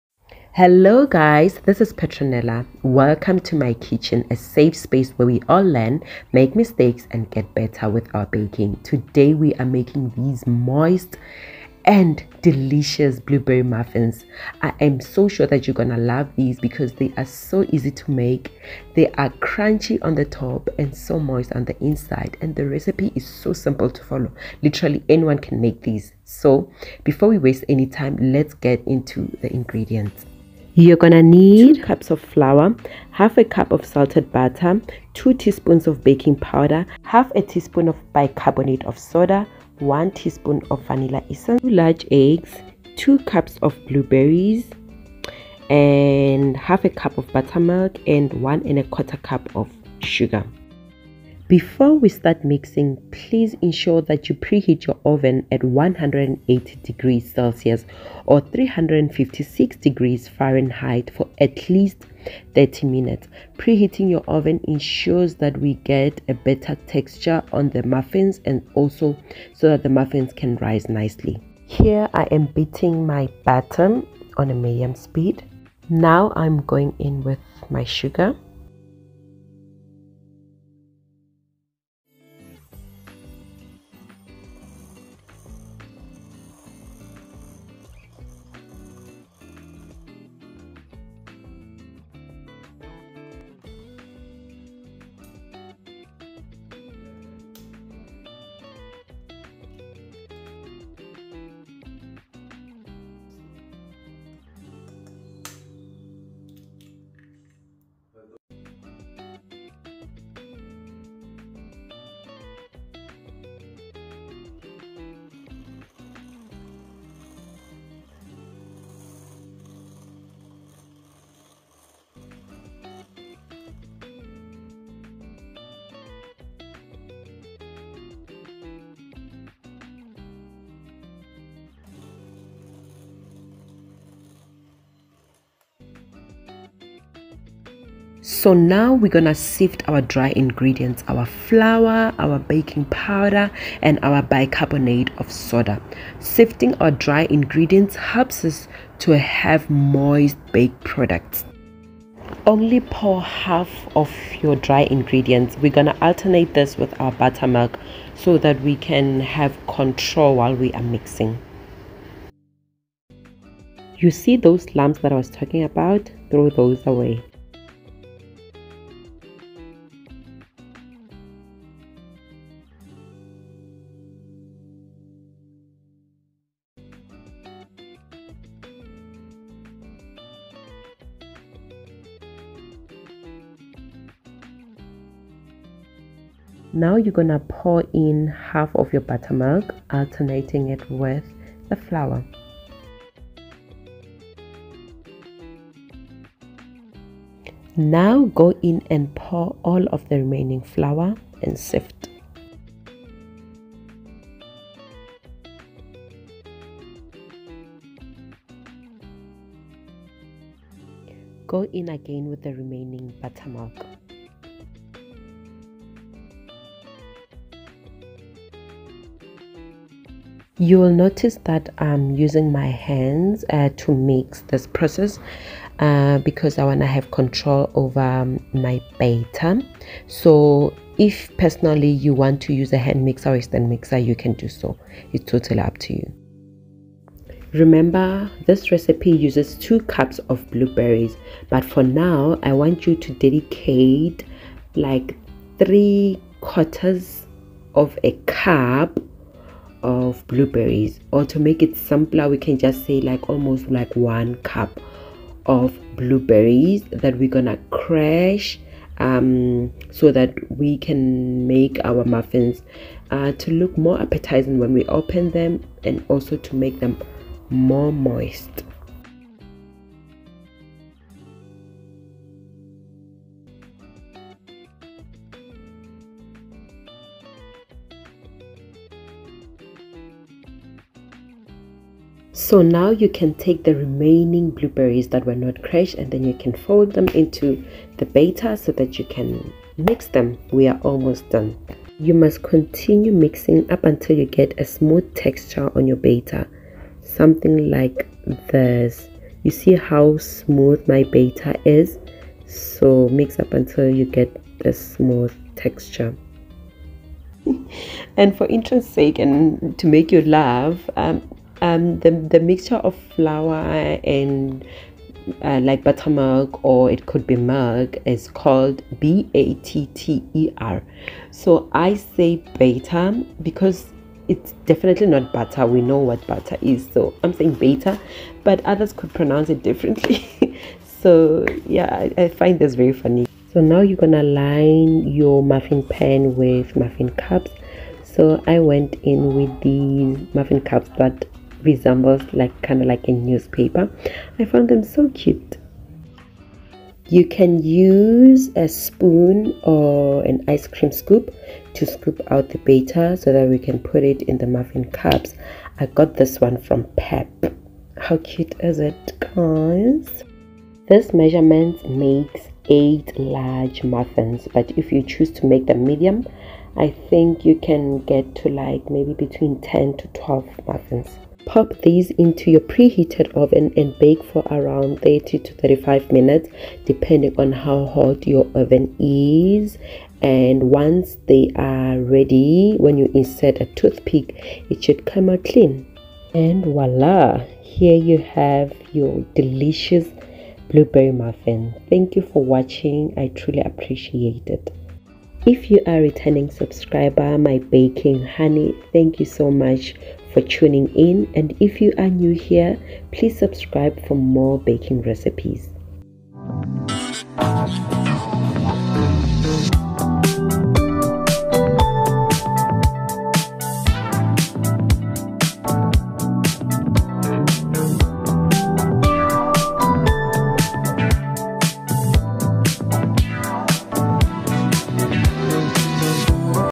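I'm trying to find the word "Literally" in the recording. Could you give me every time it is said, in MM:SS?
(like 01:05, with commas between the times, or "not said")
00:24.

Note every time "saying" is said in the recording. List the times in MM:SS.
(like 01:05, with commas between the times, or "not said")
05:27.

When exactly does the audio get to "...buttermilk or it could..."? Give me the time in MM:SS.
05:15.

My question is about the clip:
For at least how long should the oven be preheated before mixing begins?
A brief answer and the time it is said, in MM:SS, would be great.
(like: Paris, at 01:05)
30 minutes, at 01:02.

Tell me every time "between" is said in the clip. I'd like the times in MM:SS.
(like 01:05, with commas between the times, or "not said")
06:09.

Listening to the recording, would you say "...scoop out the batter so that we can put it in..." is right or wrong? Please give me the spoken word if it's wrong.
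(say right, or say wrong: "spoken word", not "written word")
right.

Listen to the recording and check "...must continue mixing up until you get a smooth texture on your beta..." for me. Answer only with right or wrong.
right.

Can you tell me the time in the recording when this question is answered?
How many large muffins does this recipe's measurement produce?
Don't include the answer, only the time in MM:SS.
06:02.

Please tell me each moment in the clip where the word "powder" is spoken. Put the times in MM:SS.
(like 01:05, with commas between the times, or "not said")
00:36, 02:22.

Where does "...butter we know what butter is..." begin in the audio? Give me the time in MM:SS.
05:25.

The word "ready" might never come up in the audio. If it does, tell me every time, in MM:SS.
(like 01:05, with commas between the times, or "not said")
06:21.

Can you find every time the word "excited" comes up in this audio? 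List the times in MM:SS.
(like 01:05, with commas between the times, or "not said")
not said.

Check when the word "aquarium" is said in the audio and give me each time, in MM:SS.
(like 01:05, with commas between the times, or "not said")
not said.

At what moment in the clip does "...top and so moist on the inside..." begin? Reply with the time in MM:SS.
00:20.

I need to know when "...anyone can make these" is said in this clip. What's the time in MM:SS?
00:25.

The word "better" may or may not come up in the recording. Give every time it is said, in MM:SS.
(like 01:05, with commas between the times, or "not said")
00:07, 01:06.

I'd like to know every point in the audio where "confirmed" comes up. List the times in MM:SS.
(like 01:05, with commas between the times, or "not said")
not said.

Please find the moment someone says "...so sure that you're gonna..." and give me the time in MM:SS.
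00:14.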